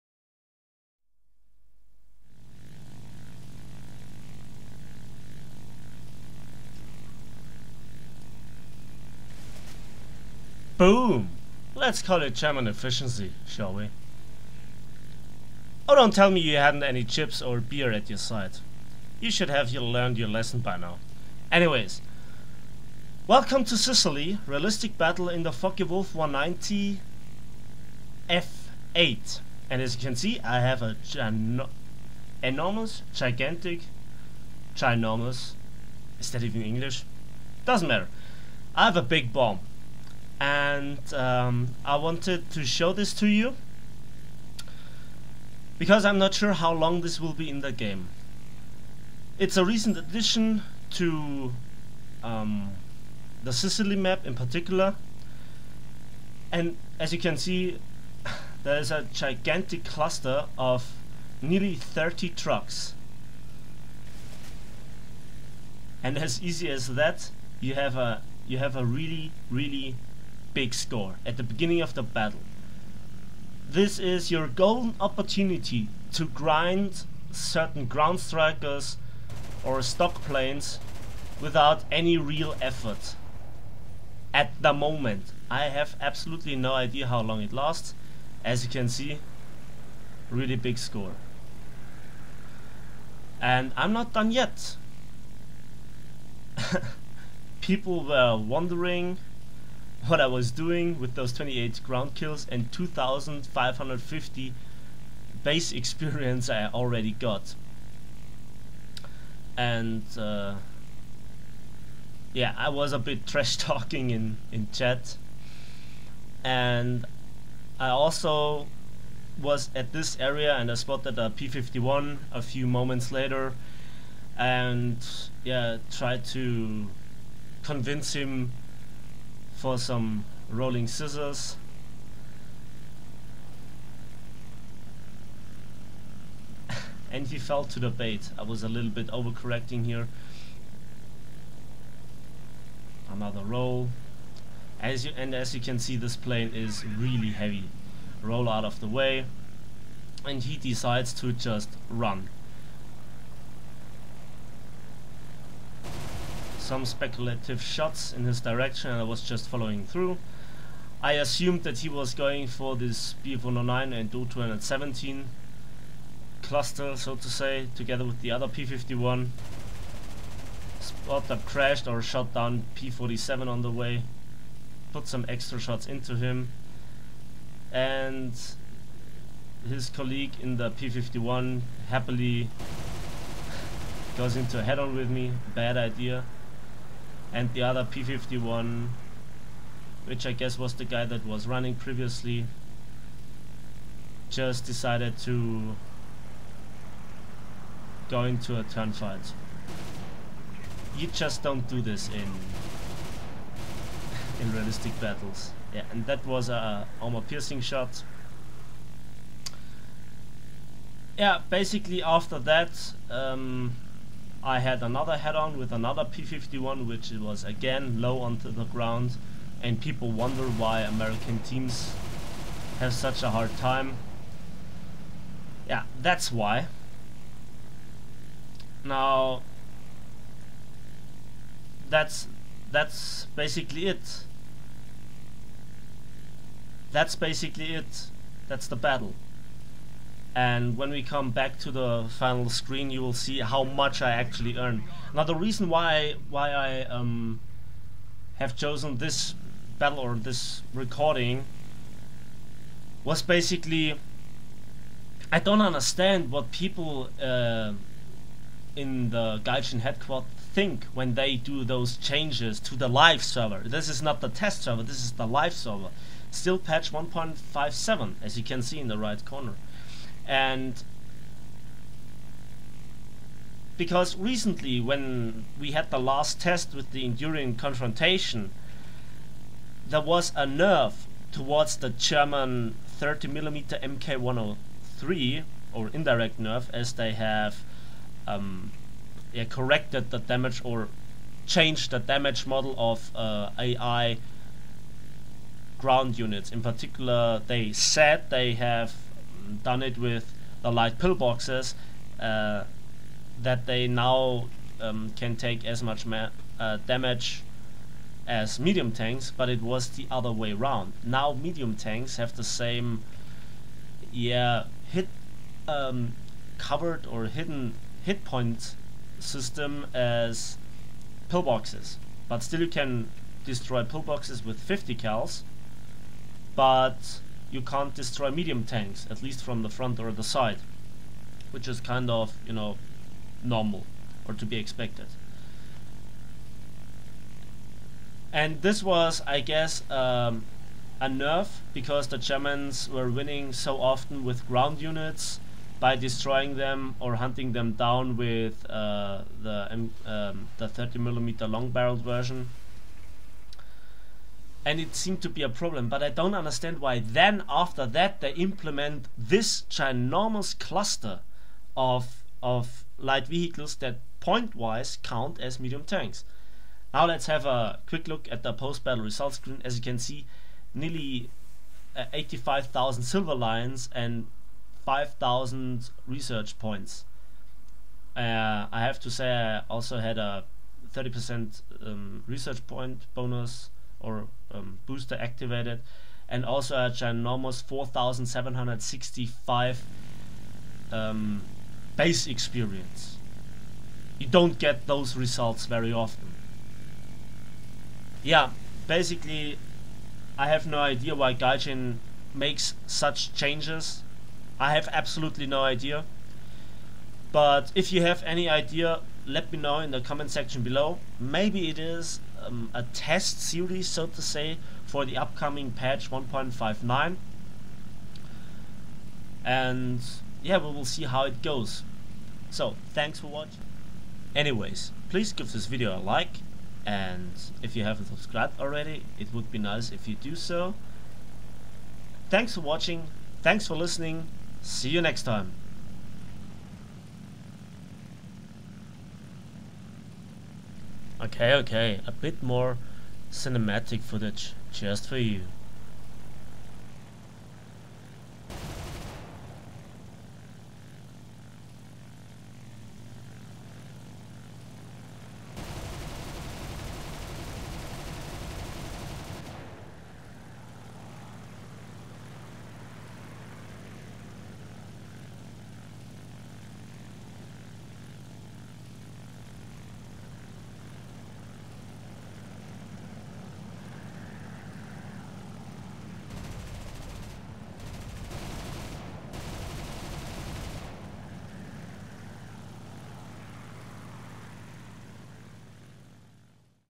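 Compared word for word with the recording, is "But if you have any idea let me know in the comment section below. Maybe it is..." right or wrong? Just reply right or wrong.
right.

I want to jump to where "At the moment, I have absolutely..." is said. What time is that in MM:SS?
01:24.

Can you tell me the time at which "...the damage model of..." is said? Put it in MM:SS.
04:51.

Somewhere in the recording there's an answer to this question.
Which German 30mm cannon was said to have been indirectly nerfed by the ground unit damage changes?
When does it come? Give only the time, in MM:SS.
04:43.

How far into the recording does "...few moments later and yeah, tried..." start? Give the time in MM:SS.
02:02.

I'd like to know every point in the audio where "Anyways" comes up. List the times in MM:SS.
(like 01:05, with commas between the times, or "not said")
00:21, 07:04.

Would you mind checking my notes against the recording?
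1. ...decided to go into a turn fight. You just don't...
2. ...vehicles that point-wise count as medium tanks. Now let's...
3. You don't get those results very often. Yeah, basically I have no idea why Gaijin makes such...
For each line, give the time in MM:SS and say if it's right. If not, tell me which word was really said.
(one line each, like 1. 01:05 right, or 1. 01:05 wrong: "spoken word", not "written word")
1. 03:14 right
2. 06:03 right
3. 06:34 right.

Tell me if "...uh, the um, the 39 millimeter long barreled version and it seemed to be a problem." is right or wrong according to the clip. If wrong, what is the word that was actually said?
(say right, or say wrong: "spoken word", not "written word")
wrong: "30", not "39".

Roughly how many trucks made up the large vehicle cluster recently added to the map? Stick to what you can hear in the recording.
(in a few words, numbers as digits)
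nearly 30.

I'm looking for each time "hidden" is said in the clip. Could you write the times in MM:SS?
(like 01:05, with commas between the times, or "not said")
05:17.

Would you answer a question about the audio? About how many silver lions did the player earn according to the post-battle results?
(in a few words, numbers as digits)
85,000.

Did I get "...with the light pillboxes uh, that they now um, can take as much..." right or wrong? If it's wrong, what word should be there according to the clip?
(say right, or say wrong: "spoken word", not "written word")
right.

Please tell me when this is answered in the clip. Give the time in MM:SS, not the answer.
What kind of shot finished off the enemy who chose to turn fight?
03:27.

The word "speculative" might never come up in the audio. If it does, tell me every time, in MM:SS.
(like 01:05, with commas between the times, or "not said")
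02:36.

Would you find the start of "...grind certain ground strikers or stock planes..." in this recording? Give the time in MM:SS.
01:16.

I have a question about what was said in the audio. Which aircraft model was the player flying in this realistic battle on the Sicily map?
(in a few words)
Focke Wulf 190 F8.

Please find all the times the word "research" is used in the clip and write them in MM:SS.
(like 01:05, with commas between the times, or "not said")
06:16, 06:22.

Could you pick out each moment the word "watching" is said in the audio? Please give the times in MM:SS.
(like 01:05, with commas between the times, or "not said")
07:03, 07:12.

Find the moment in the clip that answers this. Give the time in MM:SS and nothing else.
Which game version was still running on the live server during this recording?
04:26.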